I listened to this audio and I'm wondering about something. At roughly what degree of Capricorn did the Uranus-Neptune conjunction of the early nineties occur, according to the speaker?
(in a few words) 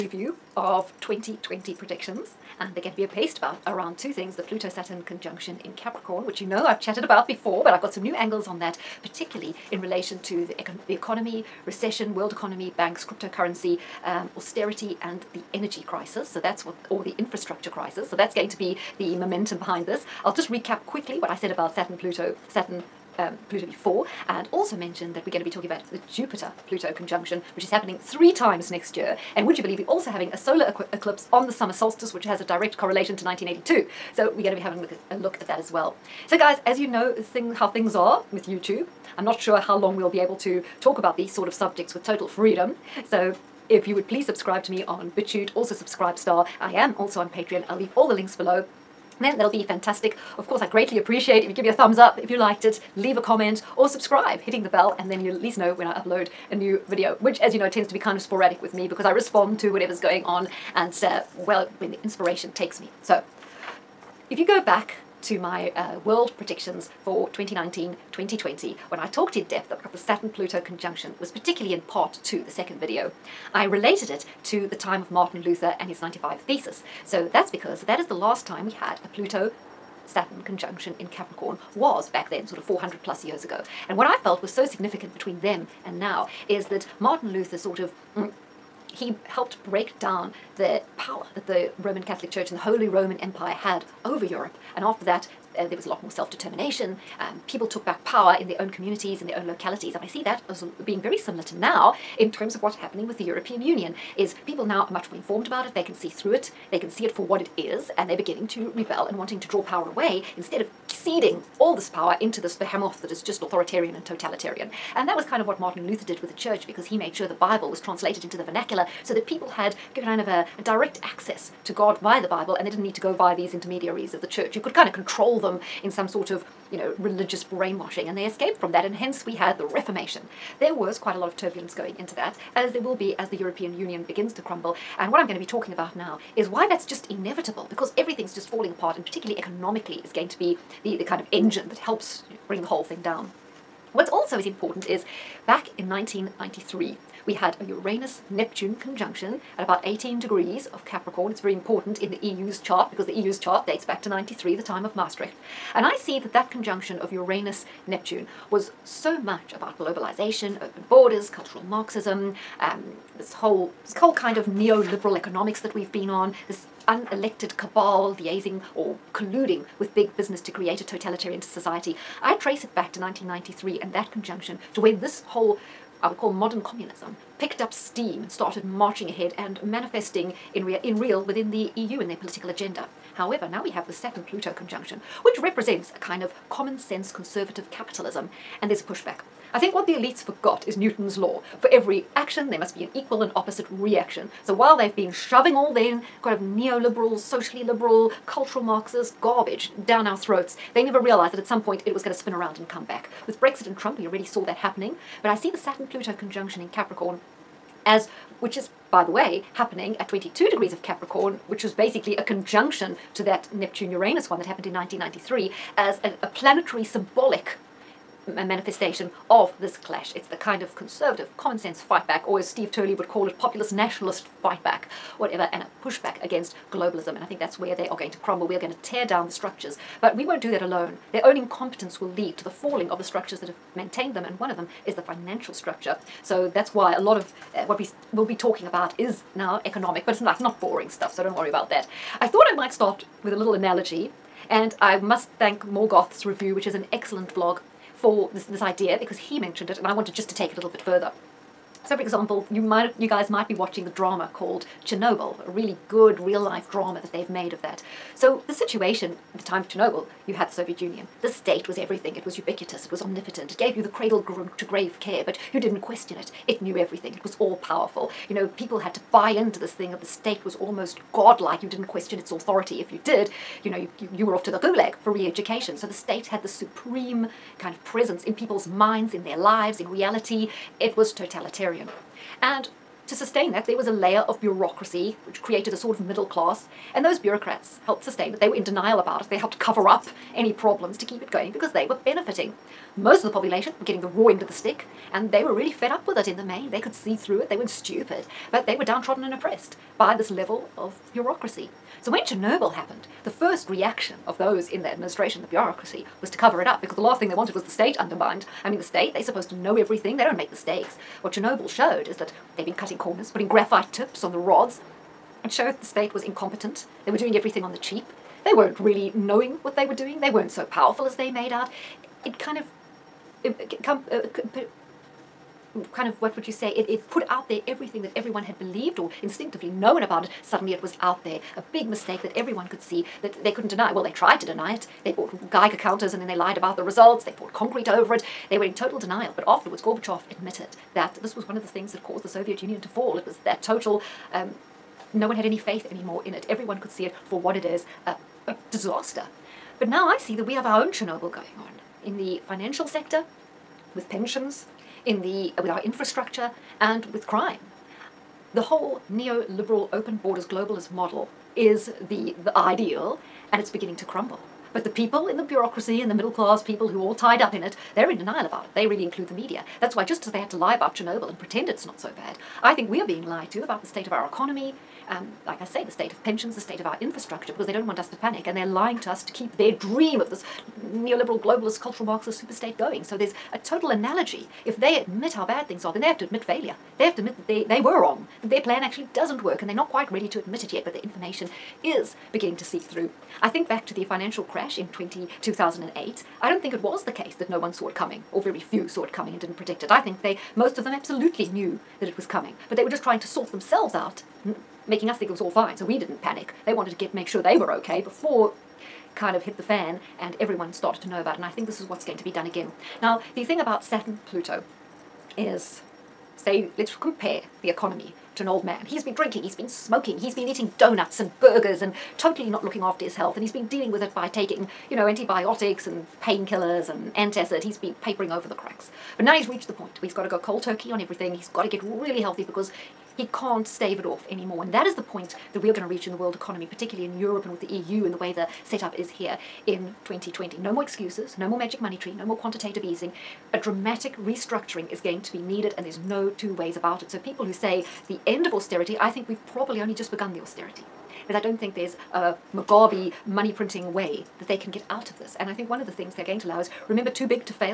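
18 degrees.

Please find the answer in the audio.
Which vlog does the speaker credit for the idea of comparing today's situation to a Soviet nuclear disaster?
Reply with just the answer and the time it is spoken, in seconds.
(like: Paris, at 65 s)
Morgoth's review, at 245 s.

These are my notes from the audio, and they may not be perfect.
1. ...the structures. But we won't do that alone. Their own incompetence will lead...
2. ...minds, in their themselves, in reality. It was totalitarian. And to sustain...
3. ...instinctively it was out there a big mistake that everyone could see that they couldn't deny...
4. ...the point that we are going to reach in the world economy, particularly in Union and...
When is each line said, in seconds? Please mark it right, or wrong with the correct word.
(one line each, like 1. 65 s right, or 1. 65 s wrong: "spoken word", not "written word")
1. 229 s right
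2. 278 s wrong: "lives", not "themselves"
3. 330 s wrong: "suddenly", not "instinctively"
4. 434 s wrong: "Europe", not "Union".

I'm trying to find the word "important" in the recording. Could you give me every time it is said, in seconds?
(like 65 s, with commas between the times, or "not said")
144 s, 151 s.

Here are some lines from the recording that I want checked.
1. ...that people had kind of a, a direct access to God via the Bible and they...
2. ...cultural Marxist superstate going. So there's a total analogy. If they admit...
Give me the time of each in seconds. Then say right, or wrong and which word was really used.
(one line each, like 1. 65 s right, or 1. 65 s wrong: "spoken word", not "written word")
1. 119 s right
2. 381 s right.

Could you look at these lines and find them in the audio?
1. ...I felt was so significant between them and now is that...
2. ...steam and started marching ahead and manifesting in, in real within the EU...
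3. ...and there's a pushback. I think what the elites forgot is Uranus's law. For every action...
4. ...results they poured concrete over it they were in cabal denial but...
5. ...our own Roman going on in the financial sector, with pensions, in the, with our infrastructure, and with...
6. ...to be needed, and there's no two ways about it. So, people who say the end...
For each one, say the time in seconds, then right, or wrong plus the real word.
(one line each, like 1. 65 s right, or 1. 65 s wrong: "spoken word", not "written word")
1. 84 s right
2. 177 s right
3. 188 s wrong: "Newton", not "Uranus"
4. 336 s wrong: "total", not "cabal"
5. 350 s wrong: "Chernobyl", not "Roman"
6. 445 s right.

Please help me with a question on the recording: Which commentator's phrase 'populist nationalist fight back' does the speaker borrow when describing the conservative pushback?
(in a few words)
Steve Turley.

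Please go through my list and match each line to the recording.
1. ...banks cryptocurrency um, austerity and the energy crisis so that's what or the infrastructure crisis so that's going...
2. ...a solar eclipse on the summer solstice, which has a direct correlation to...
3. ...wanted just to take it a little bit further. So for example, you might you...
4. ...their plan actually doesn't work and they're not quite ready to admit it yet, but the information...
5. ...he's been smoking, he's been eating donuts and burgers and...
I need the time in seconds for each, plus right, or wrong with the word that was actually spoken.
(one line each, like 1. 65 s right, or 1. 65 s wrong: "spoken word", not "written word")
1. 12 s right
2. 30 s right
3. 249 s right
4. 388 s right
5. 419 s right.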